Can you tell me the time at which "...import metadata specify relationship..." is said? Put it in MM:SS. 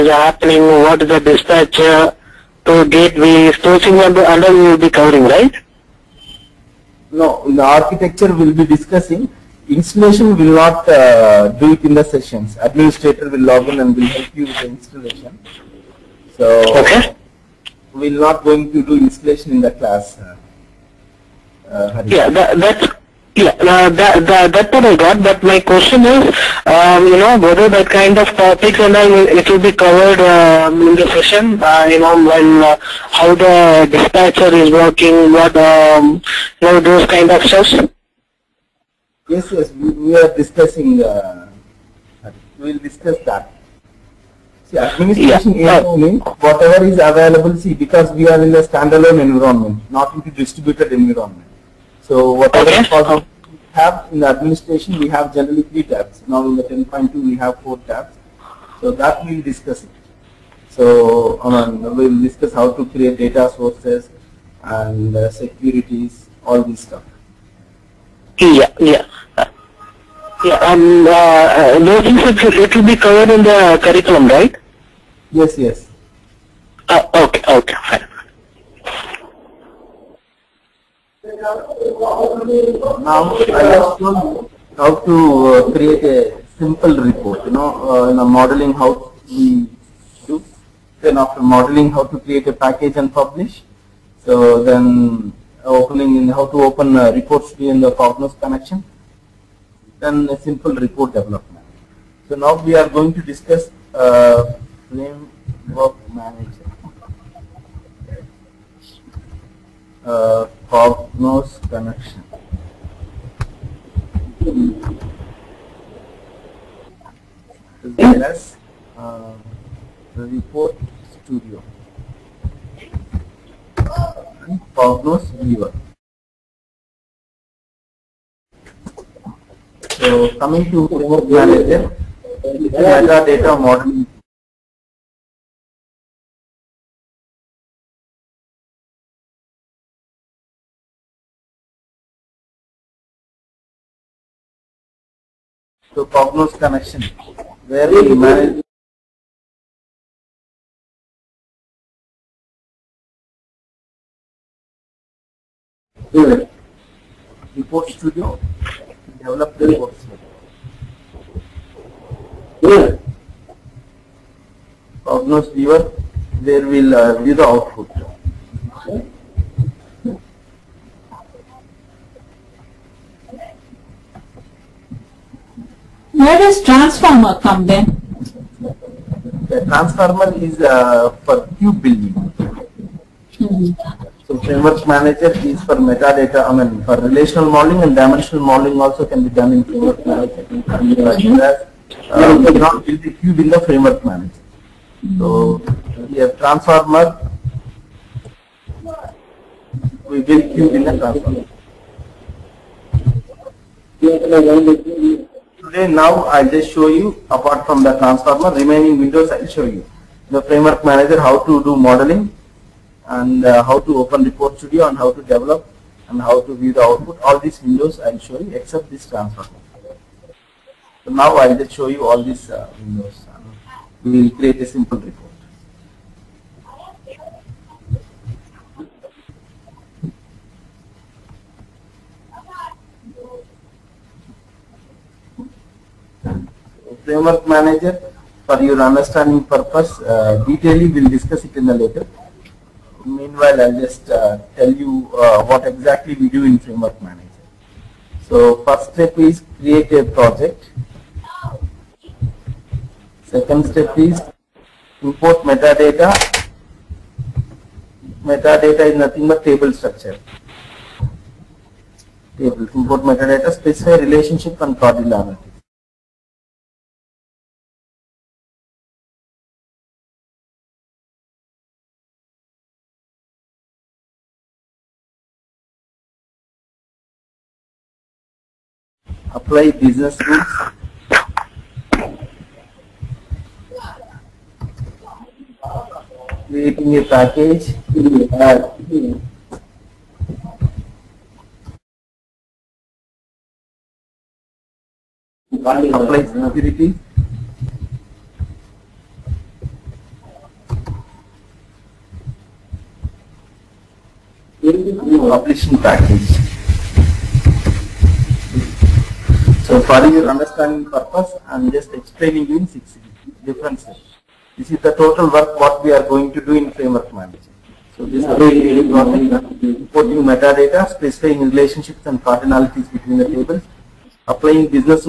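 04:22.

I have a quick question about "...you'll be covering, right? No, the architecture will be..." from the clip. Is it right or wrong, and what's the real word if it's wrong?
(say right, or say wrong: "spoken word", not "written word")
right.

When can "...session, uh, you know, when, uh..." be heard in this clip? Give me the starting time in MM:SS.
00:31.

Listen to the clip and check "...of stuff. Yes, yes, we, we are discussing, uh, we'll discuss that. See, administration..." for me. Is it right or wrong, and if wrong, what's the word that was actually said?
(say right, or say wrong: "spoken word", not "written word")
right.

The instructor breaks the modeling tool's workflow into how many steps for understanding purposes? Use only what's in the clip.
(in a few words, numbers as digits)
6.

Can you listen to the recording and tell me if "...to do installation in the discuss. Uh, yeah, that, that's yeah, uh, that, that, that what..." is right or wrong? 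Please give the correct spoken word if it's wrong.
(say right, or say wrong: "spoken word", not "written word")
wrong: "class", not "discuss".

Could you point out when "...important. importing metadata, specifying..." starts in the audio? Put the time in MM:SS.
05:18.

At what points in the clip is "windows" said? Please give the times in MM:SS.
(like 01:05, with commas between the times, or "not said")
03:28, 03:37, 03:42.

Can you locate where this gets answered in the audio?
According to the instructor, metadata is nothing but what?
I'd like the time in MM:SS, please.
04:19.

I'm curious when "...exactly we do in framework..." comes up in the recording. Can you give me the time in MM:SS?
04:05.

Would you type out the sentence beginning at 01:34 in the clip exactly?
So then uh, opening in how to open uh, reports in the Cognos connection.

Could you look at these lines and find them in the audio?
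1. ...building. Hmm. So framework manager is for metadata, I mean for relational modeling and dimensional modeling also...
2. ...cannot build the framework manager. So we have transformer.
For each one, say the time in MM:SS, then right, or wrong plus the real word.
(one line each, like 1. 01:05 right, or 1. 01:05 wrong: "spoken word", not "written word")
1. 03:01 right
2. 03:12 right.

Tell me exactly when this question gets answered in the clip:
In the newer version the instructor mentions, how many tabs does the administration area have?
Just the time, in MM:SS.
00:57.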